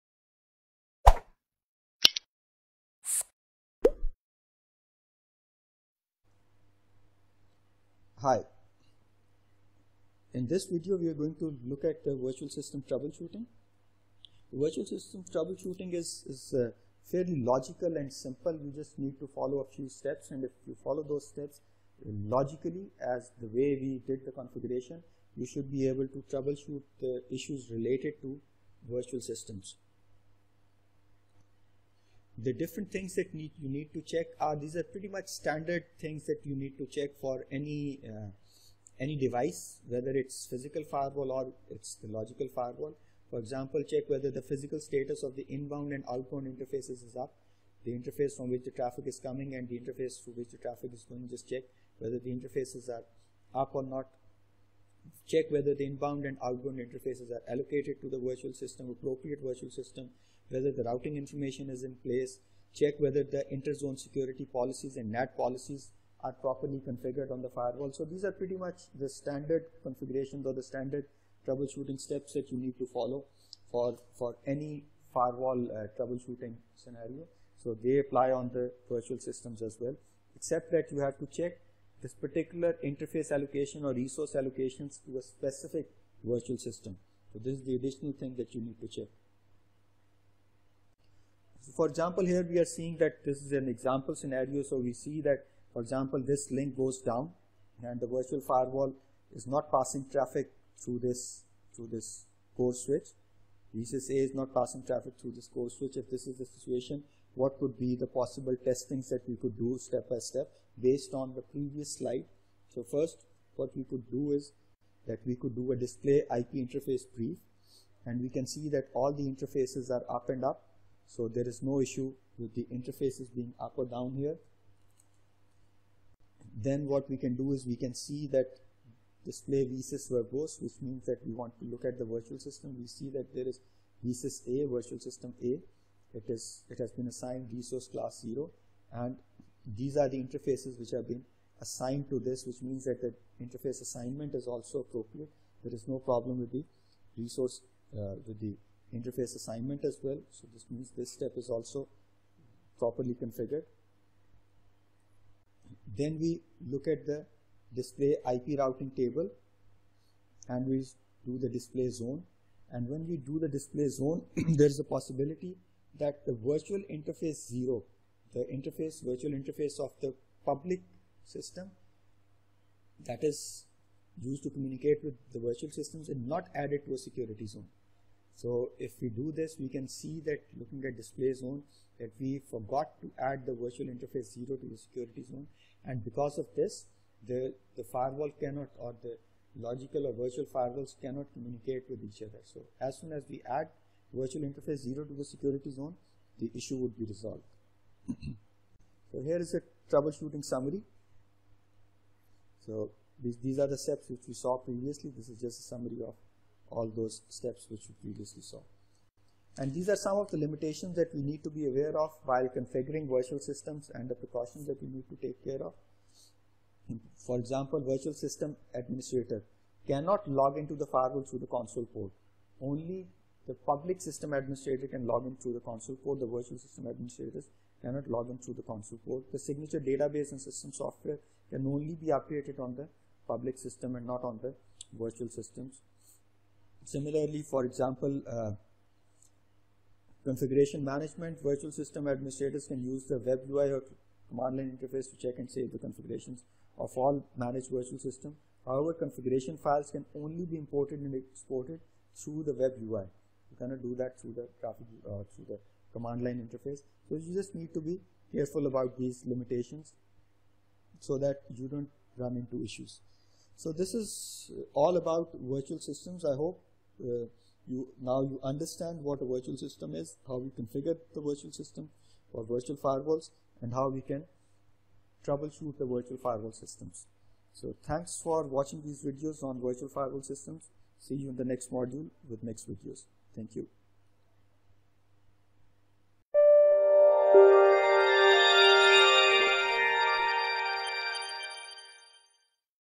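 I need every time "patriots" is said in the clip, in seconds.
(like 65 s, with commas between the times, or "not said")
not said.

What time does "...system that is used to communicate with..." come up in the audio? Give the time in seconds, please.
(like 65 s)
171 s.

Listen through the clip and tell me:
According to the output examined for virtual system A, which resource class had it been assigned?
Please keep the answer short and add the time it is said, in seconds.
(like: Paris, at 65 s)
resource class 0, at 137 s.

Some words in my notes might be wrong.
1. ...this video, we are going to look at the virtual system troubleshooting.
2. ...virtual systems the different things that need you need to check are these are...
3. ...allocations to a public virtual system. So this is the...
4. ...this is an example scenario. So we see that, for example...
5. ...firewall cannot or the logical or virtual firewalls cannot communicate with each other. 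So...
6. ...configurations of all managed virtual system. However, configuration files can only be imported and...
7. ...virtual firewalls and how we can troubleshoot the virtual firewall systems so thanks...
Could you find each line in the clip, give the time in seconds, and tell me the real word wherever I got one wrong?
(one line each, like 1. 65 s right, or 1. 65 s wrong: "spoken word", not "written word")
1. 10 s right
2. 28 s right
3. 84 s wrong: "specific", not "public"
4. 93 s right
5. 187 s right
6. 245 s right
7. 272 s right.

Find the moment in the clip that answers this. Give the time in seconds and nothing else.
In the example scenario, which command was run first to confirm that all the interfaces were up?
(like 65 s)
115 s.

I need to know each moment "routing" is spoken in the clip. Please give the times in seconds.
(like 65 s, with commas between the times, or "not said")
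60 s, 158 s.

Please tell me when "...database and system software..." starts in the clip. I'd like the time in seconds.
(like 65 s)
229 s.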